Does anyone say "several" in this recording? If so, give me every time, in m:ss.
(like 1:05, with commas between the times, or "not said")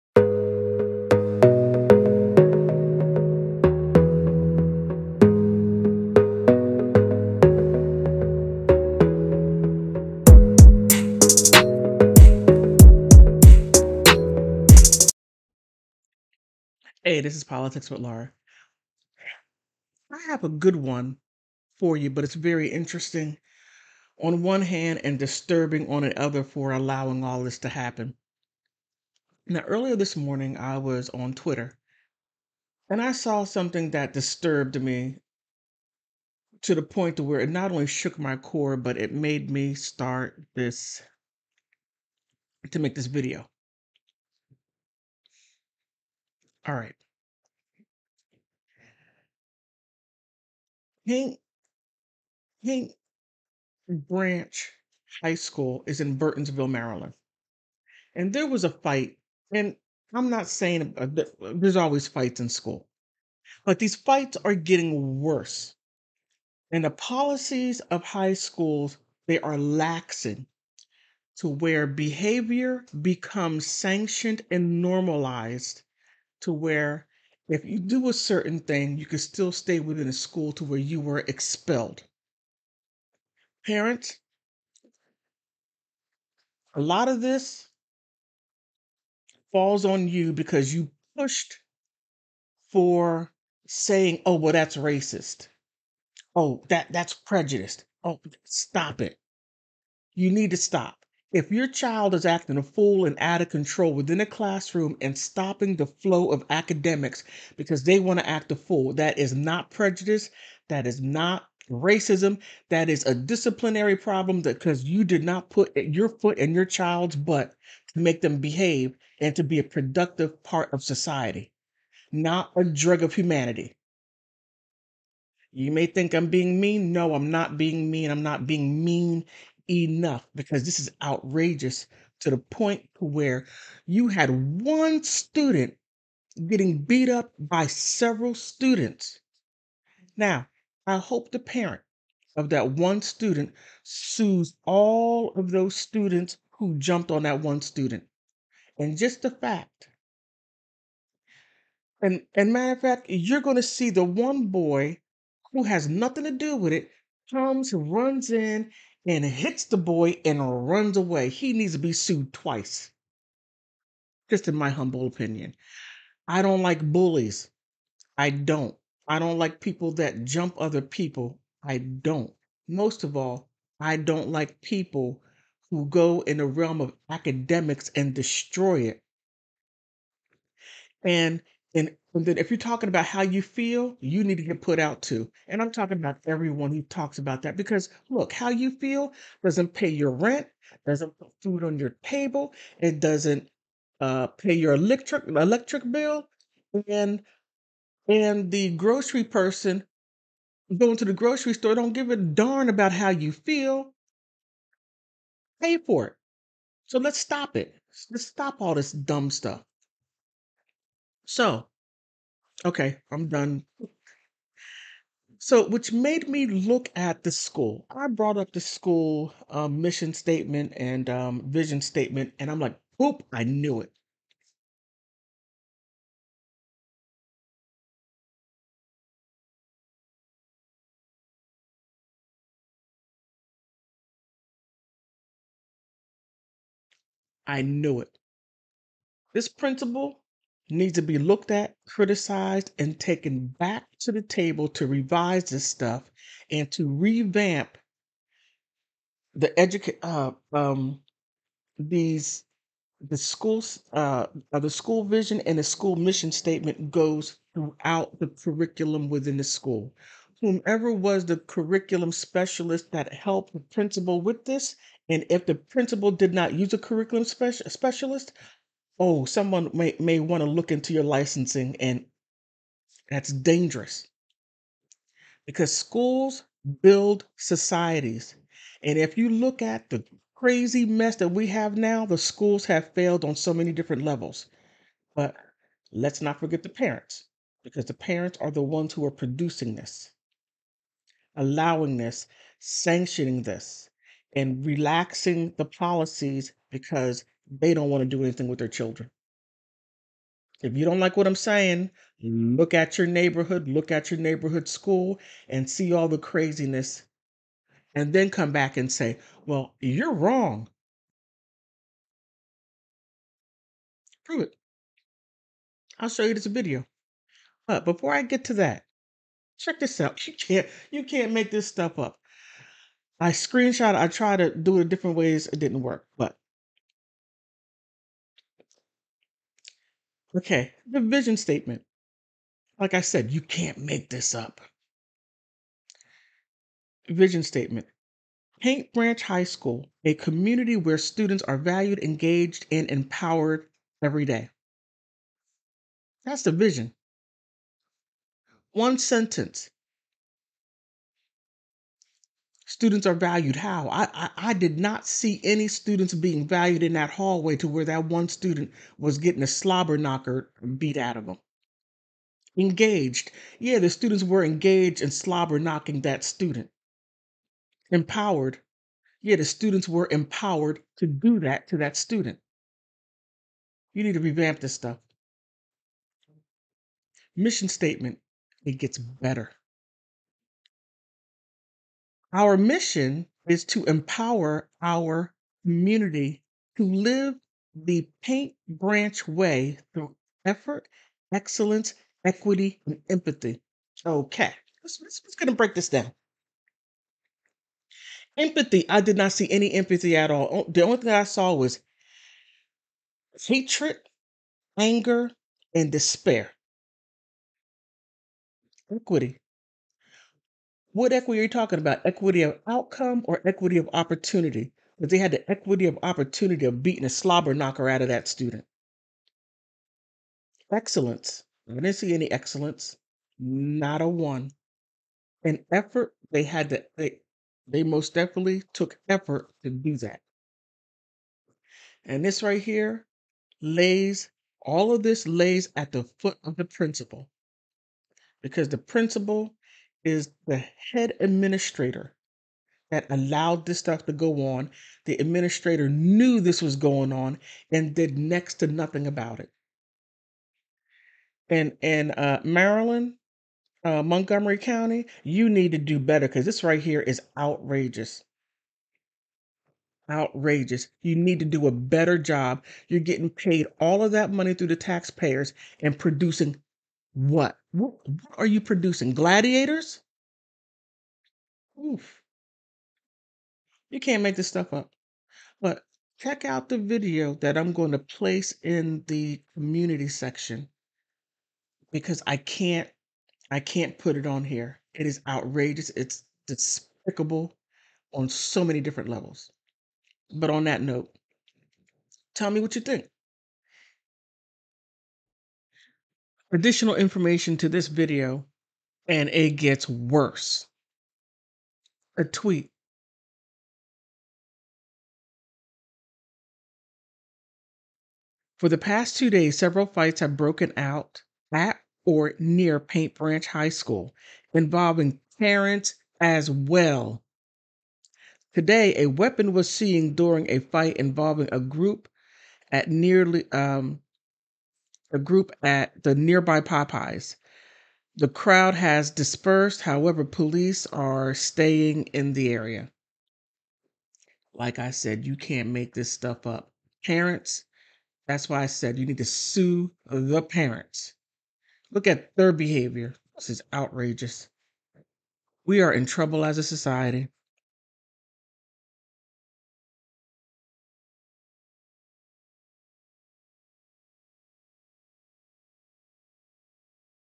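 2:17, 8:29.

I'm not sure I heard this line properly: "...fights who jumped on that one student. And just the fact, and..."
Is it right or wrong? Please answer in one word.
wrong.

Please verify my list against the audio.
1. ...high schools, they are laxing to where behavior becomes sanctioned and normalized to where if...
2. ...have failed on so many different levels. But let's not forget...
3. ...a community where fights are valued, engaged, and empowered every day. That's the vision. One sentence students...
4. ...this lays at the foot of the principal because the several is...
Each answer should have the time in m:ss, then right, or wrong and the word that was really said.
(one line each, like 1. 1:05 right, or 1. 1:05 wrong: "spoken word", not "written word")
1. 1:08 right
2. 4:42 right
3. 5:40 wrong: "students", not "fights"
4. 7:15 wrong: "principal", not "several".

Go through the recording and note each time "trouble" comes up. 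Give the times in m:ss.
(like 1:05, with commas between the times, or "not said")
9:06.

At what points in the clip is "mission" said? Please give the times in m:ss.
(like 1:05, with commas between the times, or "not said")
3:39, 4:15, 6:17, 6:22.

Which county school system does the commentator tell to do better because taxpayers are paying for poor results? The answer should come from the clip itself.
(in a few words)
Montgomery County.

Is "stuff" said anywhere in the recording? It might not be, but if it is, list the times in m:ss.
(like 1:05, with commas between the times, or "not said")
3:29, 4:05, 5:21, 6:14, 7:23, 7:54, 8:56.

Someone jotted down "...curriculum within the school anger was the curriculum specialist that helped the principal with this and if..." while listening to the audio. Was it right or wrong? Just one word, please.
wrong.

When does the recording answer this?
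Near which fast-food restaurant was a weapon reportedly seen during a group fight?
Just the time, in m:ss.
8:46.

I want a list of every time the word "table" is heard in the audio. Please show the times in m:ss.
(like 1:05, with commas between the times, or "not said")
3:12, 4:04.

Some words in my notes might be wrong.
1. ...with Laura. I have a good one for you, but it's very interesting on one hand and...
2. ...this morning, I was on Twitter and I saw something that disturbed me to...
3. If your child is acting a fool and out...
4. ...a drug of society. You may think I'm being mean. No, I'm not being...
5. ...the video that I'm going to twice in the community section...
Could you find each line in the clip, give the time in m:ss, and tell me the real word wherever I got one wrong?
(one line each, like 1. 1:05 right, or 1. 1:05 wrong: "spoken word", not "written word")
1. 0:17 right
2. 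0:29 right
3. 1:41 right
4. 2:02 wrong: "humanity", not "society"
5. 7:56 wrong: "place", not "twice".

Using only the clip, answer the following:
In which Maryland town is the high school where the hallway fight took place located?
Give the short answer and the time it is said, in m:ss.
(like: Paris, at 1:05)
Burtonsville, at 0:56.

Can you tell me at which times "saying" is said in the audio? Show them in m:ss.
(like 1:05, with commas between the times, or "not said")
1:00, 1:33, 5:01.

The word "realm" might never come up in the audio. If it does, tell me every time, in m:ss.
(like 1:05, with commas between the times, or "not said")
2:56.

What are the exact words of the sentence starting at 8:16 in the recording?
additional information to this video, and it gets worse.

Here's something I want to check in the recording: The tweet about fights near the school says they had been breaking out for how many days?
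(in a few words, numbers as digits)
2.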